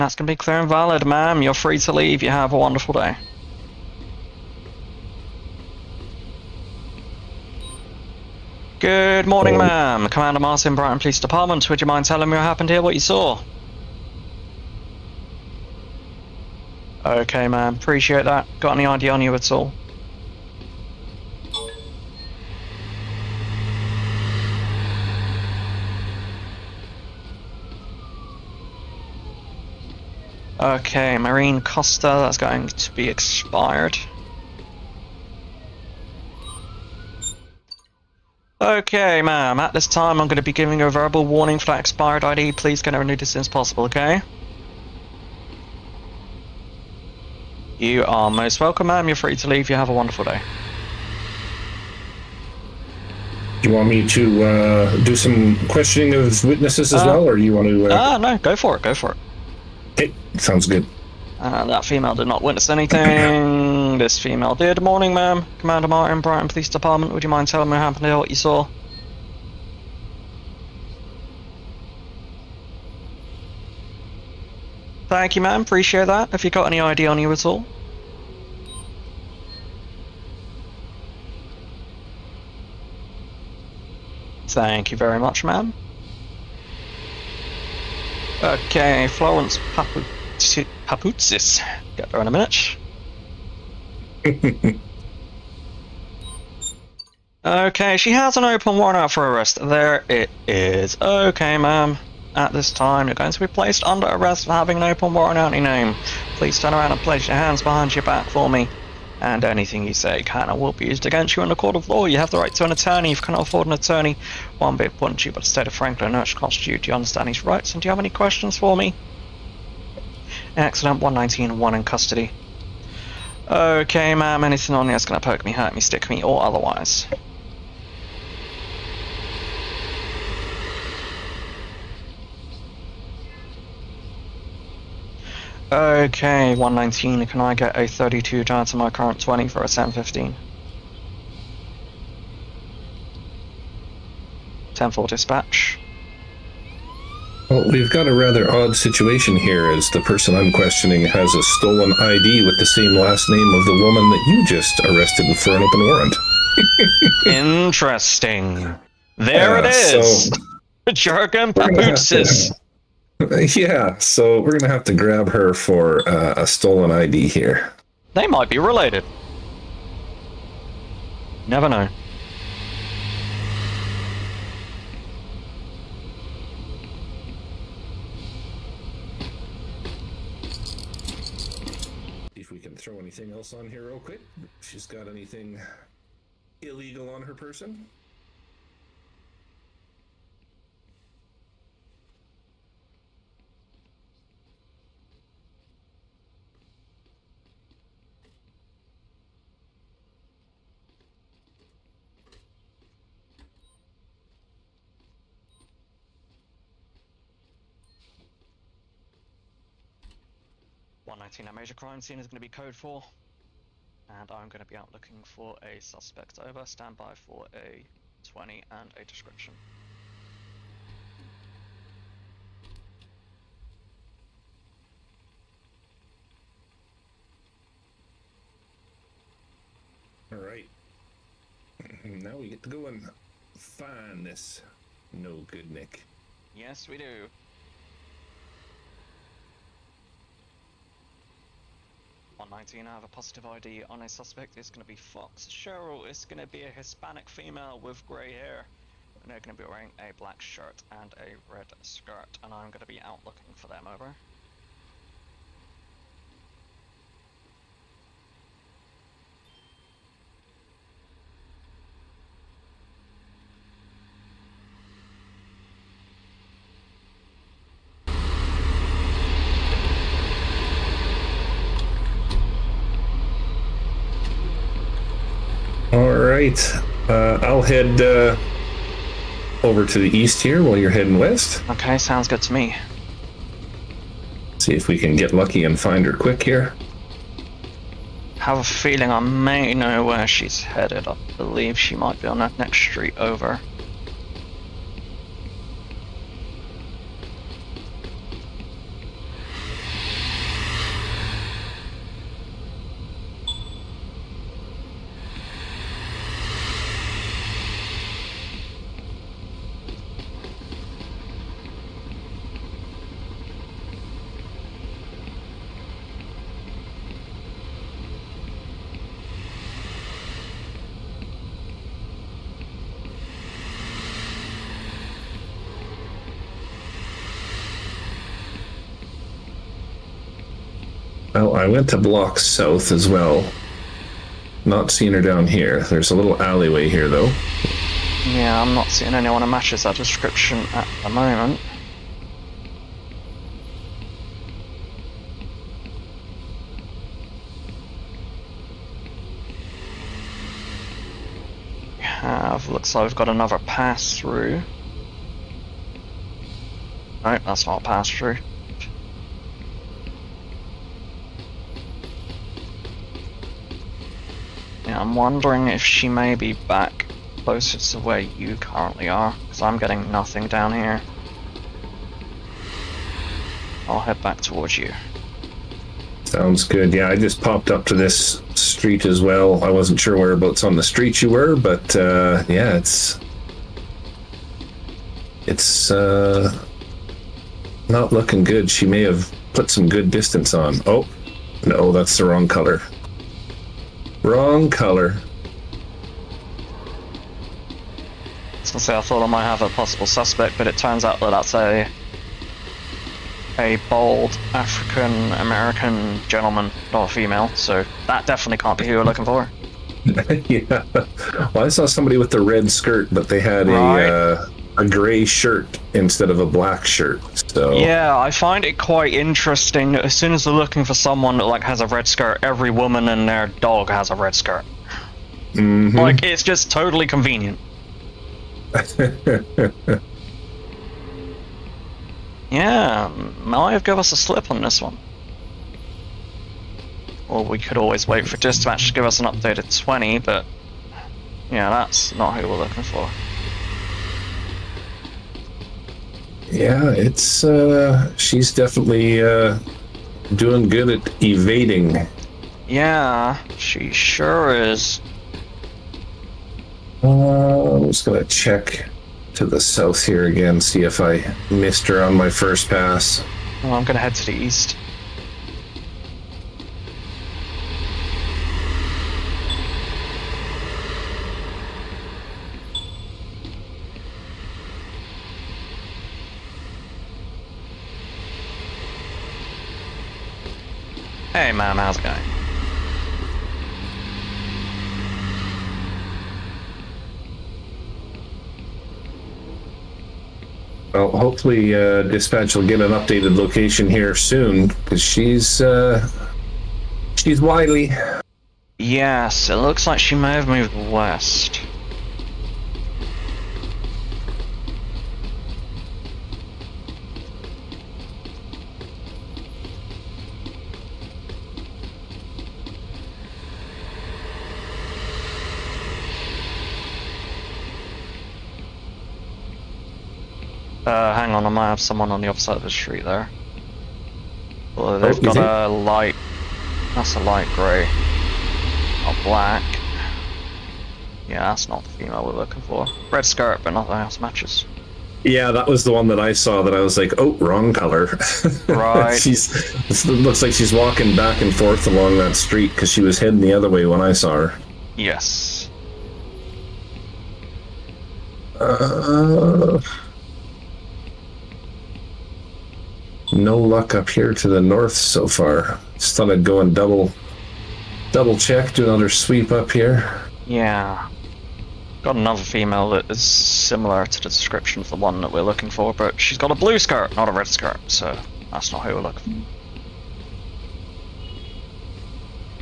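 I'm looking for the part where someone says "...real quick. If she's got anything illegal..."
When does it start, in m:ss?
3:03.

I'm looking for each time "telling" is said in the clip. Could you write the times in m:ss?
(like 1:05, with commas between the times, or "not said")
0:12, 1:07.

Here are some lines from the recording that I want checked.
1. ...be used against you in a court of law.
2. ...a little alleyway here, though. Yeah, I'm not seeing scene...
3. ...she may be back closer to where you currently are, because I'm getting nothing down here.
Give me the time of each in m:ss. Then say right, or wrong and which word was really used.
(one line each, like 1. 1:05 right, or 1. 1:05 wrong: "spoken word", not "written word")
1. 1:50 right
2. 5:36 wrong: "anyone", not "scene"
3. 6:05 right.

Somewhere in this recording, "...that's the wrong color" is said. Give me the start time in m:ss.
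6:31.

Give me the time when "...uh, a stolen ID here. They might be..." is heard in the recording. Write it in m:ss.
2:46.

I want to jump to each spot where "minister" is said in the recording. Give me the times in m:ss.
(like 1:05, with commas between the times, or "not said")
not said.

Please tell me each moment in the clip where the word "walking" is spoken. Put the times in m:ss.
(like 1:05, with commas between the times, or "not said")
9:00.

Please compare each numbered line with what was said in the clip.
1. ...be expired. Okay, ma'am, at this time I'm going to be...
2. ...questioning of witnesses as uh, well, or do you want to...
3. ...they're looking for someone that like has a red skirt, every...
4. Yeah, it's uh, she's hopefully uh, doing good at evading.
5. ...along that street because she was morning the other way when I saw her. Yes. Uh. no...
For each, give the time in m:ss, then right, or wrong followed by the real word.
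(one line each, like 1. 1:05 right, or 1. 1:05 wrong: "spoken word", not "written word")
1. 0:32 right
2. 0:55 right
3. 7:00 right
4. 7:26 wrong: "definitely", not "hopefully"
5. 9:01 wrong: "heading", not "morning".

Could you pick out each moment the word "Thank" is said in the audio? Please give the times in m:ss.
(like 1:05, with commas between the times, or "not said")
1:15, 1:24.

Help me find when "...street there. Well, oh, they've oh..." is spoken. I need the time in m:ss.
8:42.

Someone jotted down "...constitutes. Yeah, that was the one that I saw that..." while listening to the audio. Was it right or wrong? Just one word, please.
wrong.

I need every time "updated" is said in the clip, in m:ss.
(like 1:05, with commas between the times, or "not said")
7:19, 8:12.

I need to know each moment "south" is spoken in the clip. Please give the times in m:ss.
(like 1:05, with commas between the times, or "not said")
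5:32, 7:39.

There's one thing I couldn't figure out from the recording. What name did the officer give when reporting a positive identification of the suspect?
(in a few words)
Fox Cheryl.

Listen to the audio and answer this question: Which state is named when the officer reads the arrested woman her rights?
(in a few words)
Franklin.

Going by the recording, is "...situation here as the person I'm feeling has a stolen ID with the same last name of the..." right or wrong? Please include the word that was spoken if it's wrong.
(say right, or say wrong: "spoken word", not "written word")
wrong: "questioning", not "feeling".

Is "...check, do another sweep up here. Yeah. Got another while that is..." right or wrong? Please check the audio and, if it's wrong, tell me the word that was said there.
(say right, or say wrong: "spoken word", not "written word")
wrong: "female", not "while".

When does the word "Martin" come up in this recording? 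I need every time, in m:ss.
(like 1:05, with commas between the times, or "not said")
0:10, 1:05.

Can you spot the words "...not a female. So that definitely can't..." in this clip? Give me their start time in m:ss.
6:46.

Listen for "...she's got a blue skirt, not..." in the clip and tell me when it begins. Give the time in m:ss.
9:26.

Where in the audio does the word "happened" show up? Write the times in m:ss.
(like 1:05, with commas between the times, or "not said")
0:12, 1:07.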